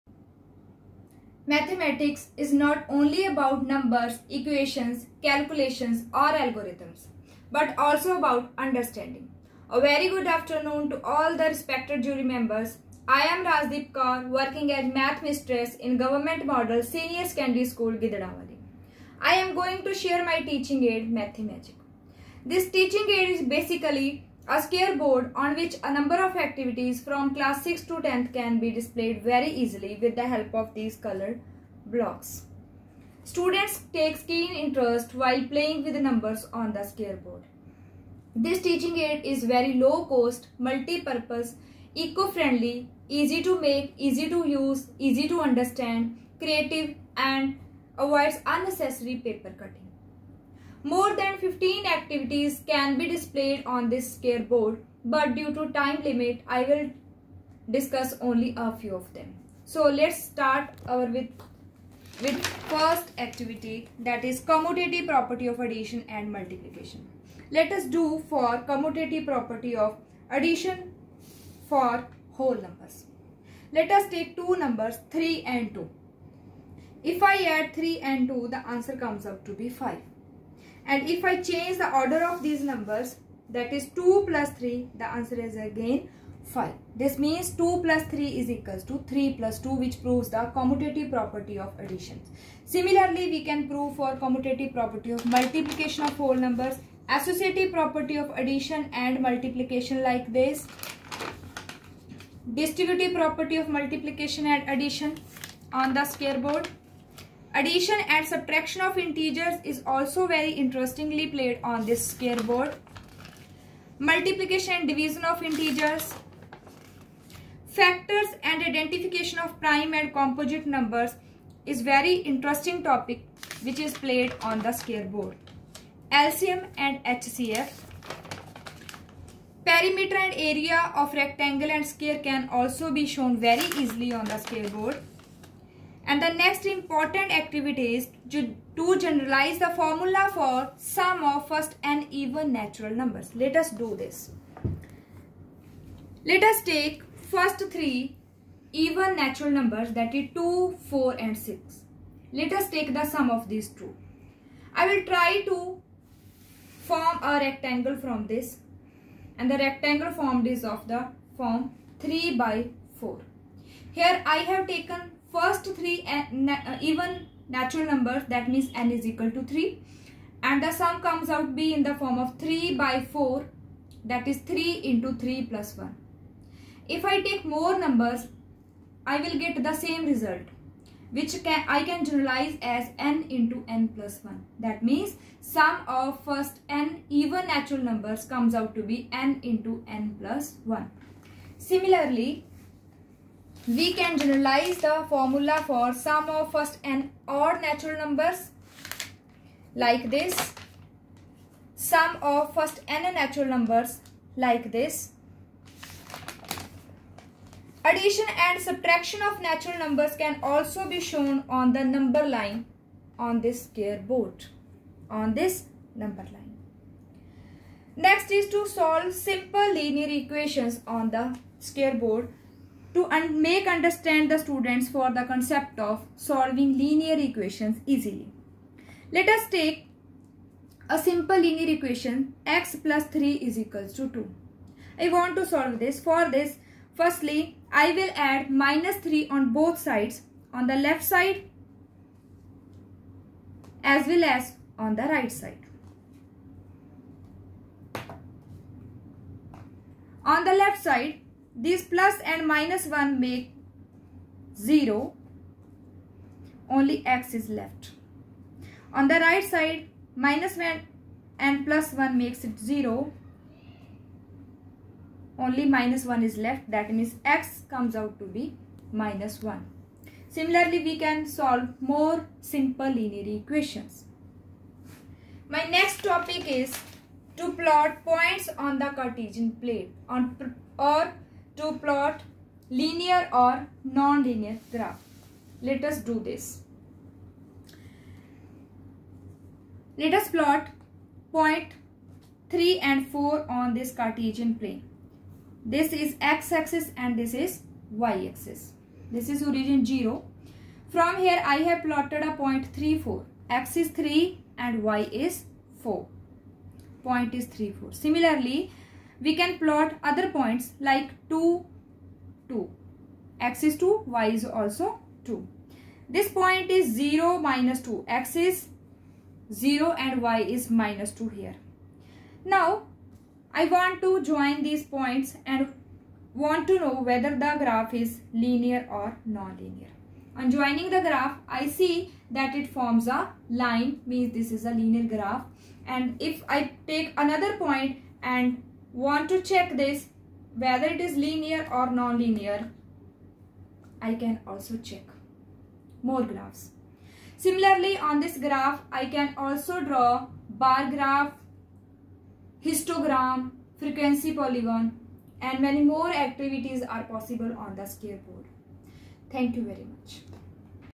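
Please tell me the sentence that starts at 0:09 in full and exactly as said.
A very good afternoon to all the respected jury members.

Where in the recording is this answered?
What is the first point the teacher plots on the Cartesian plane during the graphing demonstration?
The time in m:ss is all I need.
4:52.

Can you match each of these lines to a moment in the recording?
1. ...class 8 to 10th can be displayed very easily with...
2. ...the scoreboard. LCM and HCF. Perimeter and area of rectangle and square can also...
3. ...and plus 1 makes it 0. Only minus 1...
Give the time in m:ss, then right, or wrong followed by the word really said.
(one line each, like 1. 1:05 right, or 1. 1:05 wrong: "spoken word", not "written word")
1. 0:27 wrong: "6", not "8"
2. 2:04 right
3. 4:21 right.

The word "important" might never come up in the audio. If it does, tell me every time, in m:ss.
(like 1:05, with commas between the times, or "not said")
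2:16.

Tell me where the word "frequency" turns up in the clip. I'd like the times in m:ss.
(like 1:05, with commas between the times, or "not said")
5:53.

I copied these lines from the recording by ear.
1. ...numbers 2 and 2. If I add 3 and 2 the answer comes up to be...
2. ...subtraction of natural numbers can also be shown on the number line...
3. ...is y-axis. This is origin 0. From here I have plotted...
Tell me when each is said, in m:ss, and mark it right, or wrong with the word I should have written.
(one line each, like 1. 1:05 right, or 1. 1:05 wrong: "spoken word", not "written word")
1. 1:14 wrong: "3", not "2"
2. 3:28 right
3. 4:57 right.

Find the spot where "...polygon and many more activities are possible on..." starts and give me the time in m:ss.
5:54.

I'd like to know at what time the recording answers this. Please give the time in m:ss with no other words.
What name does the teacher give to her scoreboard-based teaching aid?
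0:21.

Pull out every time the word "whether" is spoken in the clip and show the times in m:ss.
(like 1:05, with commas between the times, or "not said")
5:27, 5:40.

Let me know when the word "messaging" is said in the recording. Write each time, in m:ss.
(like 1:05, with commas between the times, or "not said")
not said.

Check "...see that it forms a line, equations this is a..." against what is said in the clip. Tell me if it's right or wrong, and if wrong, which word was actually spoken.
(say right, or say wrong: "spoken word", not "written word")
wrong: "means", not "equations".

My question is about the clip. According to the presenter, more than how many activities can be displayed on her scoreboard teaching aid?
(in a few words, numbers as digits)
15.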